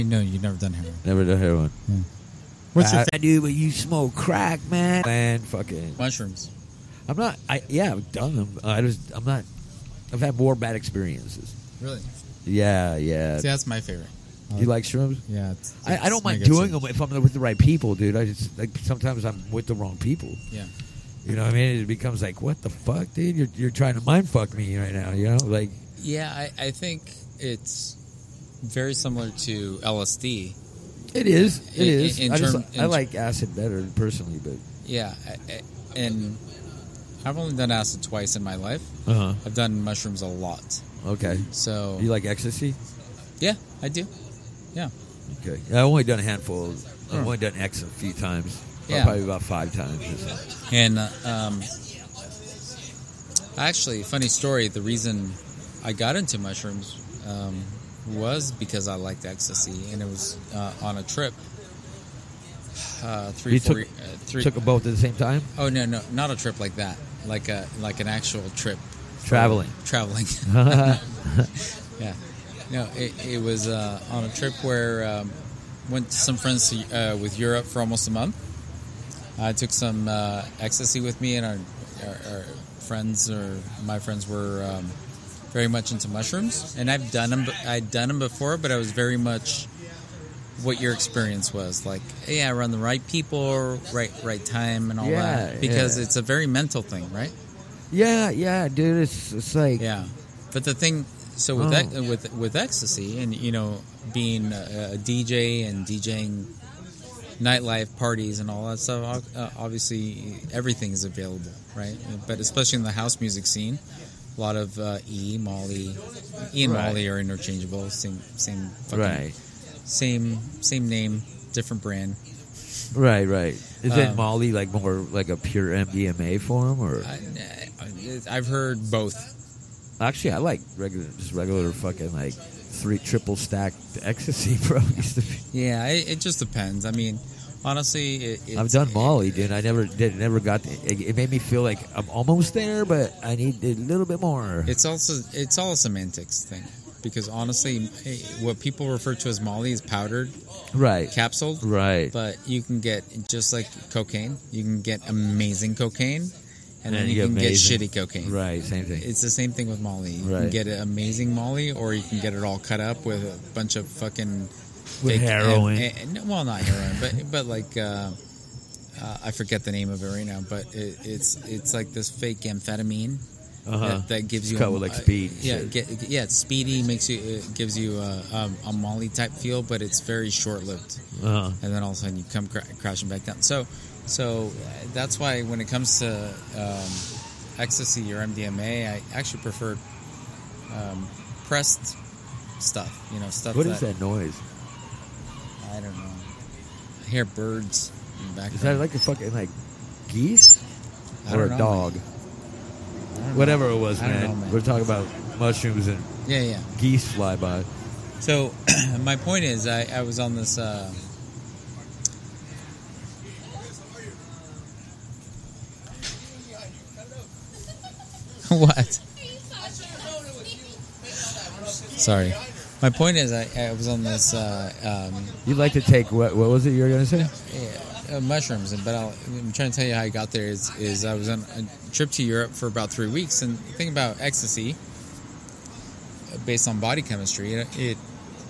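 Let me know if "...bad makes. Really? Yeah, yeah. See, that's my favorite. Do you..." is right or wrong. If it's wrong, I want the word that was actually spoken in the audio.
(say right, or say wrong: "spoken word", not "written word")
wrong: "experiences", not "makes".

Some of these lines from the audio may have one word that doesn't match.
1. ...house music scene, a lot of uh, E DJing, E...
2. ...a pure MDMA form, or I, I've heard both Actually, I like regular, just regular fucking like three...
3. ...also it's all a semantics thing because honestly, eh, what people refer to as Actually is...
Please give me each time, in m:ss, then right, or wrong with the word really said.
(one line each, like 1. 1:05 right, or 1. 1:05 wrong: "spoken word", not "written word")
1. 1:52 wrong: "Molly", not "DJing"
2. 2:05 right
3. 2:24 wrong: "Molly", not "Actually".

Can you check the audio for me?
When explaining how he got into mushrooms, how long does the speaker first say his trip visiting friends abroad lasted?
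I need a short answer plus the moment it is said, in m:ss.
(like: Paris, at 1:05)
almost a month, at 1:17.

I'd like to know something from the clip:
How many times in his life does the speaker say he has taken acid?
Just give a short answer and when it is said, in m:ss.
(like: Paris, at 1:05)
2, at 0:38.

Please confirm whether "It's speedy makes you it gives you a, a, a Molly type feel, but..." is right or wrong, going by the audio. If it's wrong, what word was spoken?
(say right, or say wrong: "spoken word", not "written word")
right.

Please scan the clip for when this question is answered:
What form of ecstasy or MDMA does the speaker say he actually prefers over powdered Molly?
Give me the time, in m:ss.
3:11.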